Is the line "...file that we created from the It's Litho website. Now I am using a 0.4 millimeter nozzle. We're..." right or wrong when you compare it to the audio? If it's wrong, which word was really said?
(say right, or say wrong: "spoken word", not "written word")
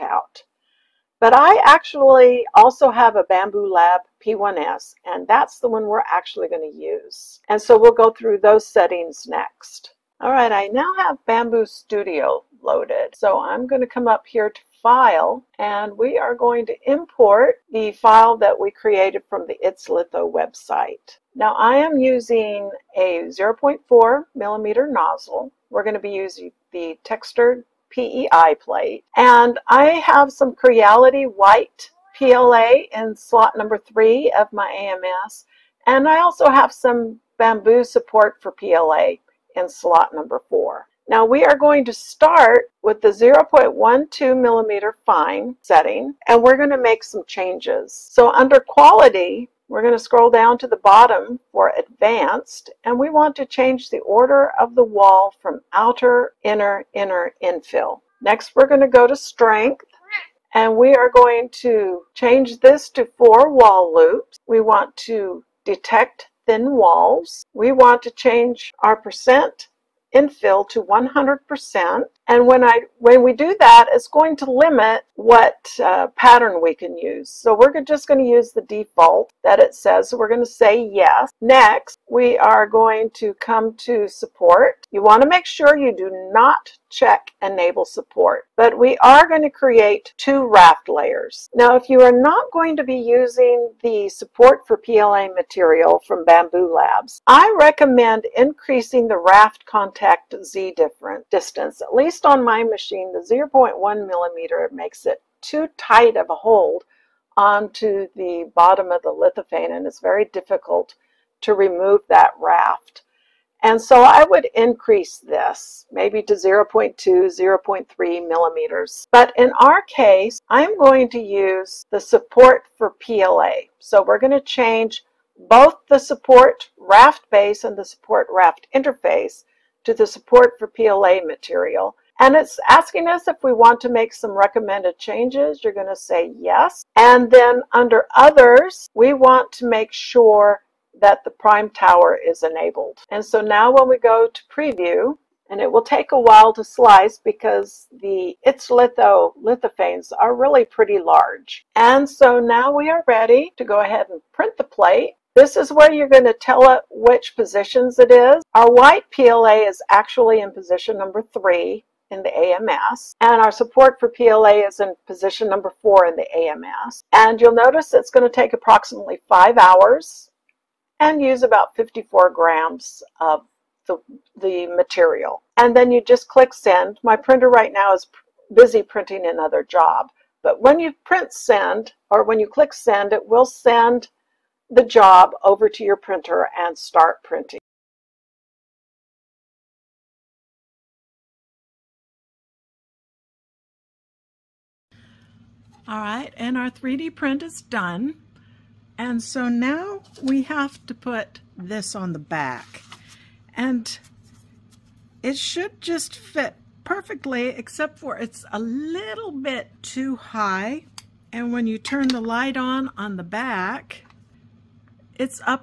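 right.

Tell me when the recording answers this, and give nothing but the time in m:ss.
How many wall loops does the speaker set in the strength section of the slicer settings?
1:03.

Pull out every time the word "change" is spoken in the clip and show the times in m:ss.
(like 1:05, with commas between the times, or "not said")
0:47, 0:53, 1:02, 1:08, 2:04, 2:14.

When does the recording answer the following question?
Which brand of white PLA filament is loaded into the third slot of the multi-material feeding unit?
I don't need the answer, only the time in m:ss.
0:30.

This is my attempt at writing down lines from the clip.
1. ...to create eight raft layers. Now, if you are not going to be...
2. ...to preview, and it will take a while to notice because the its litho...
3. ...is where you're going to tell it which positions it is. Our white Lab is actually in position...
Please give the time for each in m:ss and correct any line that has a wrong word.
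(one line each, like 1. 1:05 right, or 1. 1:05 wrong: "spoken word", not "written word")
1. 1:29 wrong: "two", not "eight"
2. 2:24 wrong: "slice", not "notice"
3. 2:35 wrong: "PLA", not "Lab".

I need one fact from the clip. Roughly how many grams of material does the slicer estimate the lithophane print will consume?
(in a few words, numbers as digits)
54 grams.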